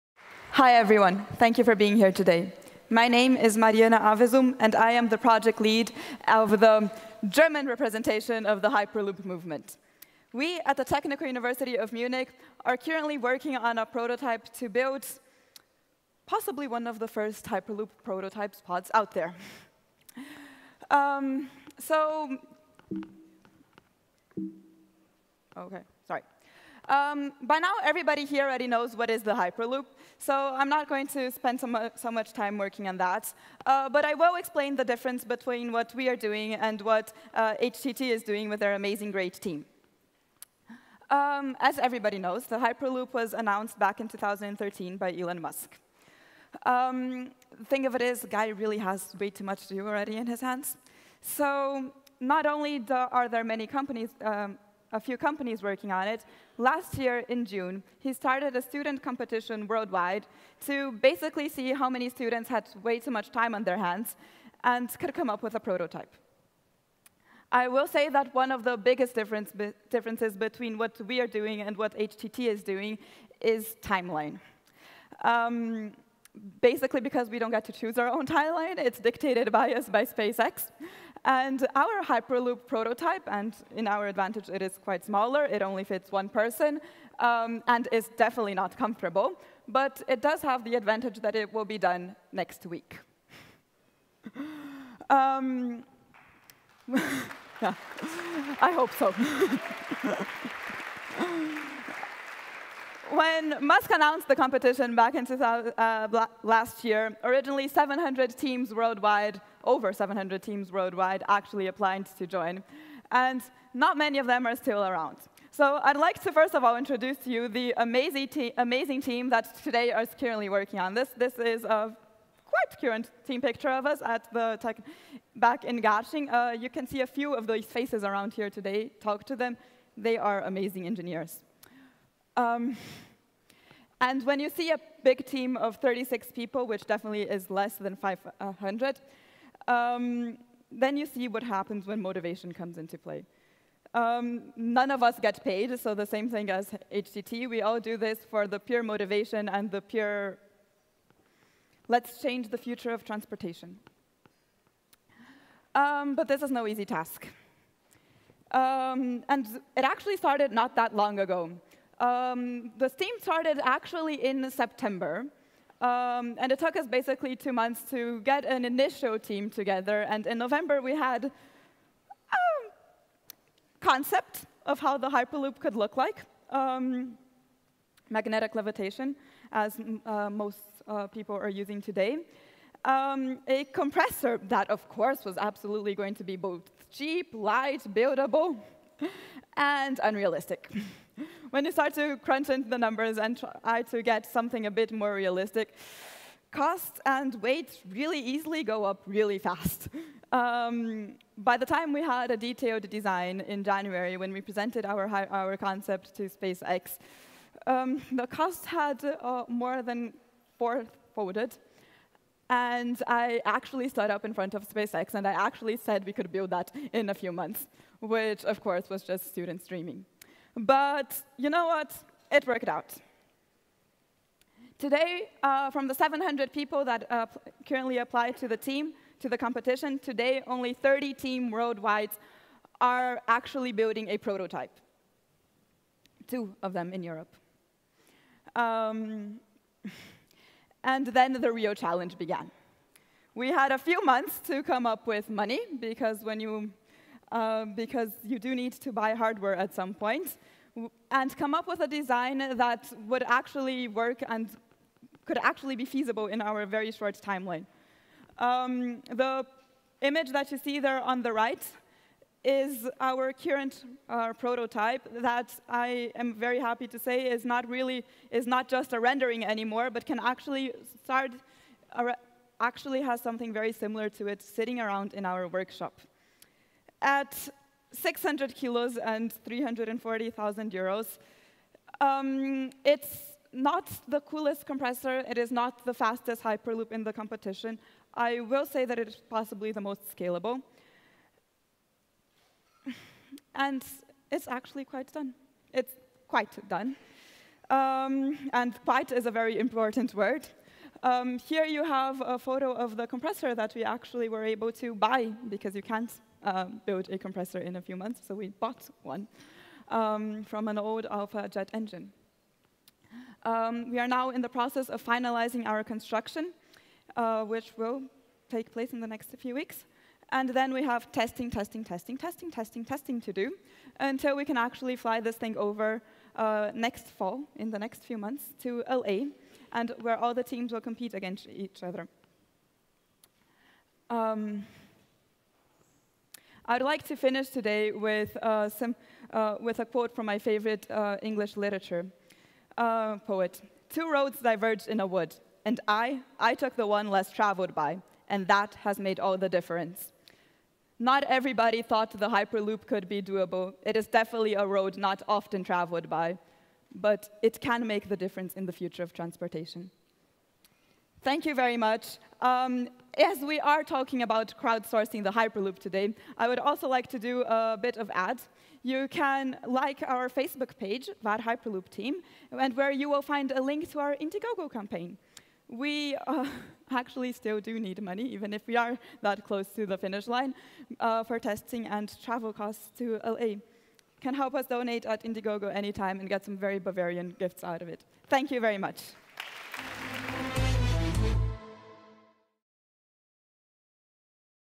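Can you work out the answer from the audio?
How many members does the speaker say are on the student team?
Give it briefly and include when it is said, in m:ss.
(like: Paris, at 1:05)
36, at 2:15.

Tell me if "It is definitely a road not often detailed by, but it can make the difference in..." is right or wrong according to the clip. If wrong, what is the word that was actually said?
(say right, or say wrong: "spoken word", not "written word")
wrong: "traveled", not "detailed".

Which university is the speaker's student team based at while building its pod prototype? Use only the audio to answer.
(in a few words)
Technical University of Munich.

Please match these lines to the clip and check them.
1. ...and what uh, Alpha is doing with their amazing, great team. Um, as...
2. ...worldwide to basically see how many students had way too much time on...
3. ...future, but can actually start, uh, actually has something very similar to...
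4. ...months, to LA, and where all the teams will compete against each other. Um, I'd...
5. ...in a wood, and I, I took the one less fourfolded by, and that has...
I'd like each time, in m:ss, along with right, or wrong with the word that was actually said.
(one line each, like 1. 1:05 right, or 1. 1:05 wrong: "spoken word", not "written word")
1. 0:36 wrong: "HTT", not "Alpha"
2. 0:59 right
3. 4:29 wrong: "anymore", not "future"
4. 5:28 right
5. 5:44 wrong: "traveled", not "fourfolded".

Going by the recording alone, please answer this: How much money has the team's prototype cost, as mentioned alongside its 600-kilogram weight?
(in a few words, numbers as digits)
340,000 euros.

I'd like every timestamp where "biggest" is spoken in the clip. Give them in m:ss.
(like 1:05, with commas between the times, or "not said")
1:08.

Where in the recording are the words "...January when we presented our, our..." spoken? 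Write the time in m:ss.
3:23.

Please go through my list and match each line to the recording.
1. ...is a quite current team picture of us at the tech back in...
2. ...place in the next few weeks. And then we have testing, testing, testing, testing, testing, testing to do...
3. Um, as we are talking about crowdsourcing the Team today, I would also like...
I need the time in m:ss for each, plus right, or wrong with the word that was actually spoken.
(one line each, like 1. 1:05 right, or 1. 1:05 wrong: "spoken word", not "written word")
1. 2:01 right
2. 5:18 right
3. 6:02 wrong: "Hyperloop", not "Team".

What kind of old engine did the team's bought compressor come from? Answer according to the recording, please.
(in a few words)
Alpha jet engine.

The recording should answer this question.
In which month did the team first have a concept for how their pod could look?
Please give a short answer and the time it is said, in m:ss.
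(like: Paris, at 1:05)
November, at 2:50.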